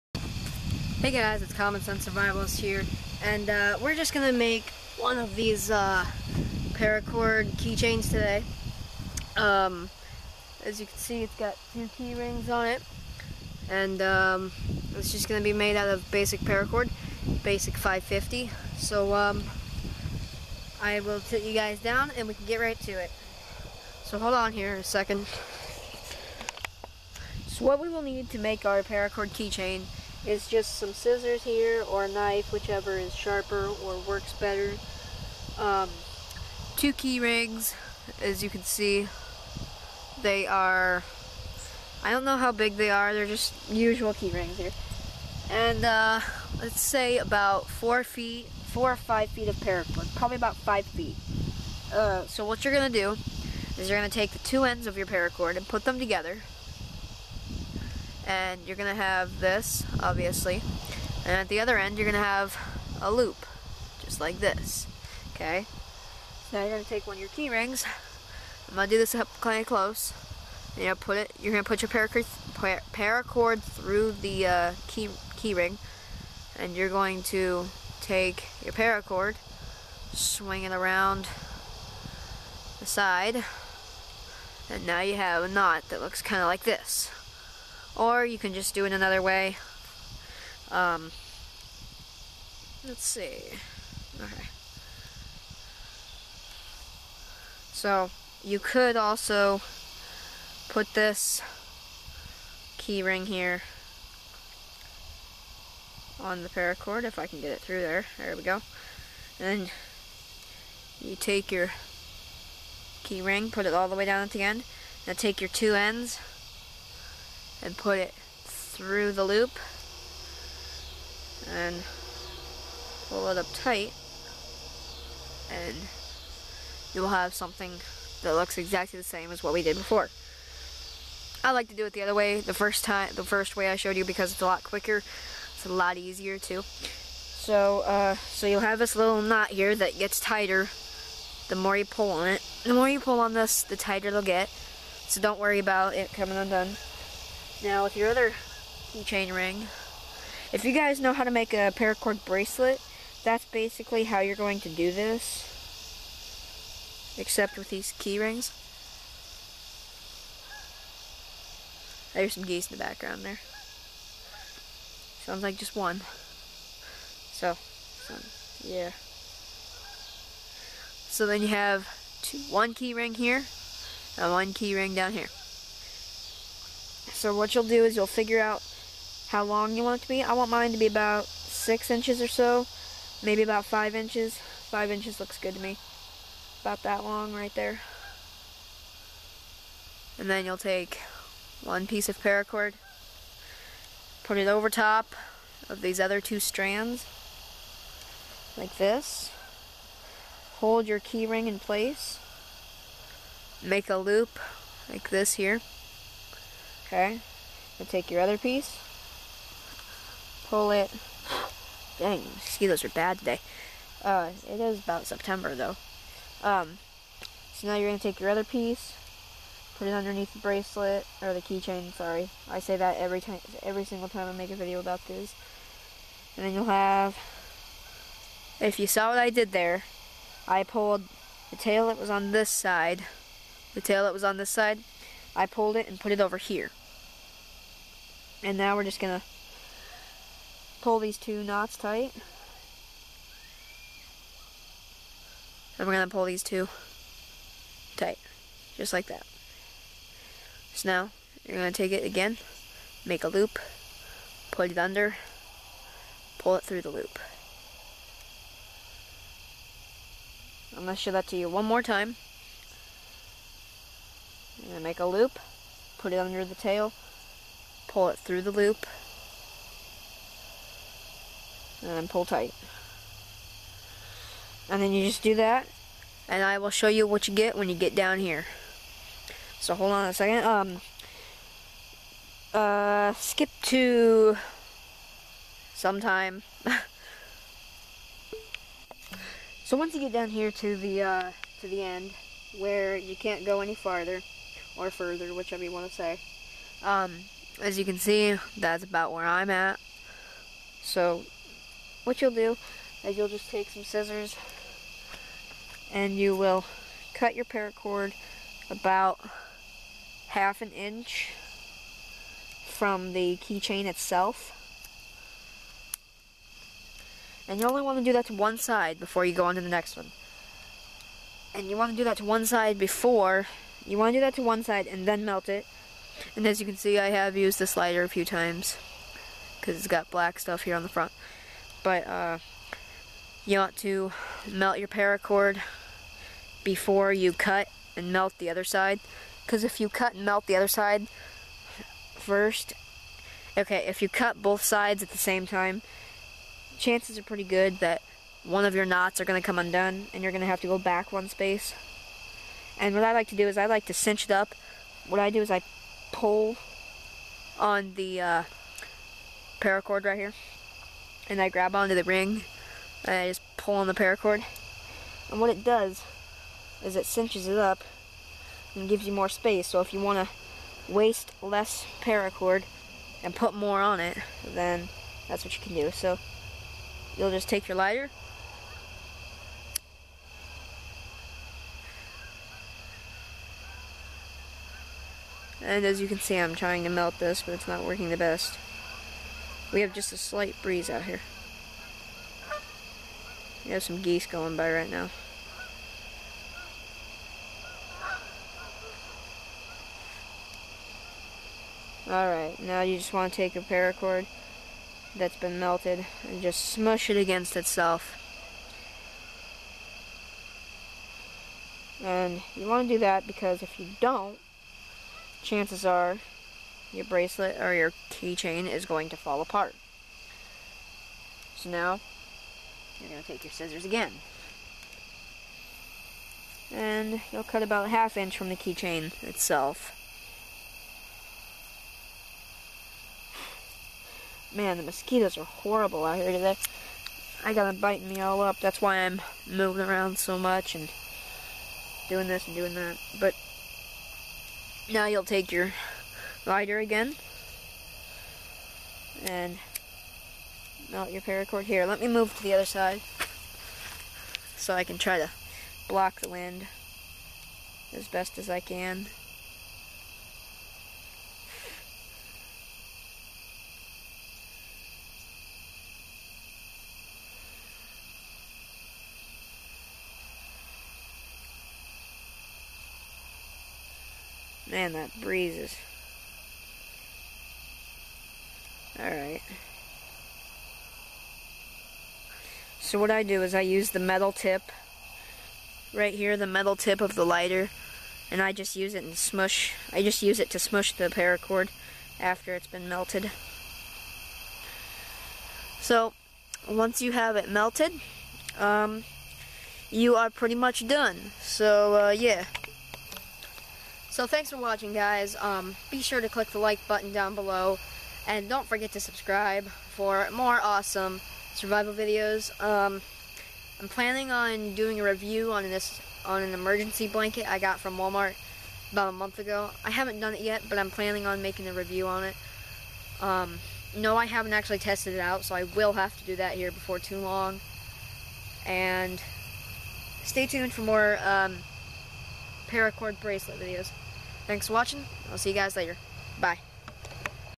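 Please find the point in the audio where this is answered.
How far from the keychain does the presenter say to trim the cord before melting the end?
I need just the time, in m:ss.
5:10.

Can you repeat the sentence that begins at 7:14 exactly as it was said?
Man, the mosquitoes are horrible out here today.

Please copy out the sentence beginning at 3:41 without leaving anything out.
Sorry, I say that every time, every single time I make a video about this.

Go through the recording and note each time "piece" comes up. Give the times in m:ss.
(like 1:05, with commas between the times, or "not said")
3:11, 3:28, 3:38.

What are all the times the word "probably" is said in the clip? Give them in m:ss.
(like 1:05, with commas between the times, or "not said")
0:50.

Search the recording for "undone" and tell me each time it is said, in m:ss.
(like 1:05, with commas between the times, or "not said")
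2:26, 5:49.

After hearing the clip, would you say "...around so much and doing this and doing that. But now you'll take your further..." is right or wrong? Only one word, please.
wrong.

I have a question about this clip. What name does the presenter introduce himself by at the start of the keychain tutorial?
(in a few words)
Common Sense Survivalist.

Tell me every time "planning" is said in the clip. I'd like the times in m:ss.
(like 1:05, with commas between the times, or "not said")
8:33, 8:40.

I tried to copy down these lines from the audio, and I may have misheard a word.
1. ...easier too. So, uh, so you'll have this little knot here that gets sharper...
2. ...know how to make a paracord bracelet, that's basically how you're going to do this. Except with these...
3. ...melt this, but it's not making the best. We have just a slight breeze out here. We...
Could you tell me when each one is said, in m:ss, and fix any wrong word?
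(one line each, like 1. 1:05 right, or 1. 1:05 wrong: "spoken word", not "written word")
1. 2:15 wrong: "tighter", not "sharper"
2. 2:30 right
3. 6:26 wrong: "working", not "making".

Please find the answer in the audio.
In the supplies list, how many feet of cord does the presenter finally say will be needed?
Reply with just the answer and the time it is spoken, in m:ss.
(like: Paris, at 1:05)
5 feet, at 0:50.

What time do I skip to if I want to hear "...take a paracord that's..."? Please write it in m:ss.
6:43.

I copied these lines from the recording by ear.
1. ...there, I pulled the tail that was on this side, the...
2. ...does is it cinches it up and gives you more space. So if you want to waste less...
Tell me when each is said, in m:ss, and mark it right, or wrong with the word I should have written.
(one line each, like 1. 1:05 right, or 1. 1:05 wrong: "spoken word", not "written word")
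1. 3:49 right
2. 6:05 right.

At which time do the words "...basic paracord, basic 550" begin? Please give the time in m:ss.
0:16.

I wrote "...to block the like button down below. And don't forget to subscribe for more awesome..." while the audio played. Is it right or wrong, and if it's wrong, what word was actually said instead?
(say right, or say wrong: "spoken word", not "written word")
wrong: "click", not "block".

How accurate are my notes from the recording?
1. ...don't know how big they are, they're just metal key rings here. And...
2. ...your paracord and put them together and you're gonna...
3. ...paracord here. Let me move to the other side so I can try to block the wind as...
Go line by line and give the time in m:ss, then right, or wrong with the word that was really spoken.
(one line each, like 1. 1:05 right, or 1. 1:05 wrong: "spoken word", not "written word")
1. 0:42 wrong: "usual", not "metal"
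2. 0:54 right
3. 7:31 right.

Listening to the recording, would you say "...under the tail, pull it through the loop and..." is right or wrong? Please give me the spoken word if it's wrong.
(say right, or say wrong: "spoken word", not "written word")
right.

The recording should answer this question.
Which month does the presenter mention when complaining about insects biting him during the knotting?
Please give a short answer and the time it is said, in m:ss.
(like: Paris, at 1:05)
September, at 3:35.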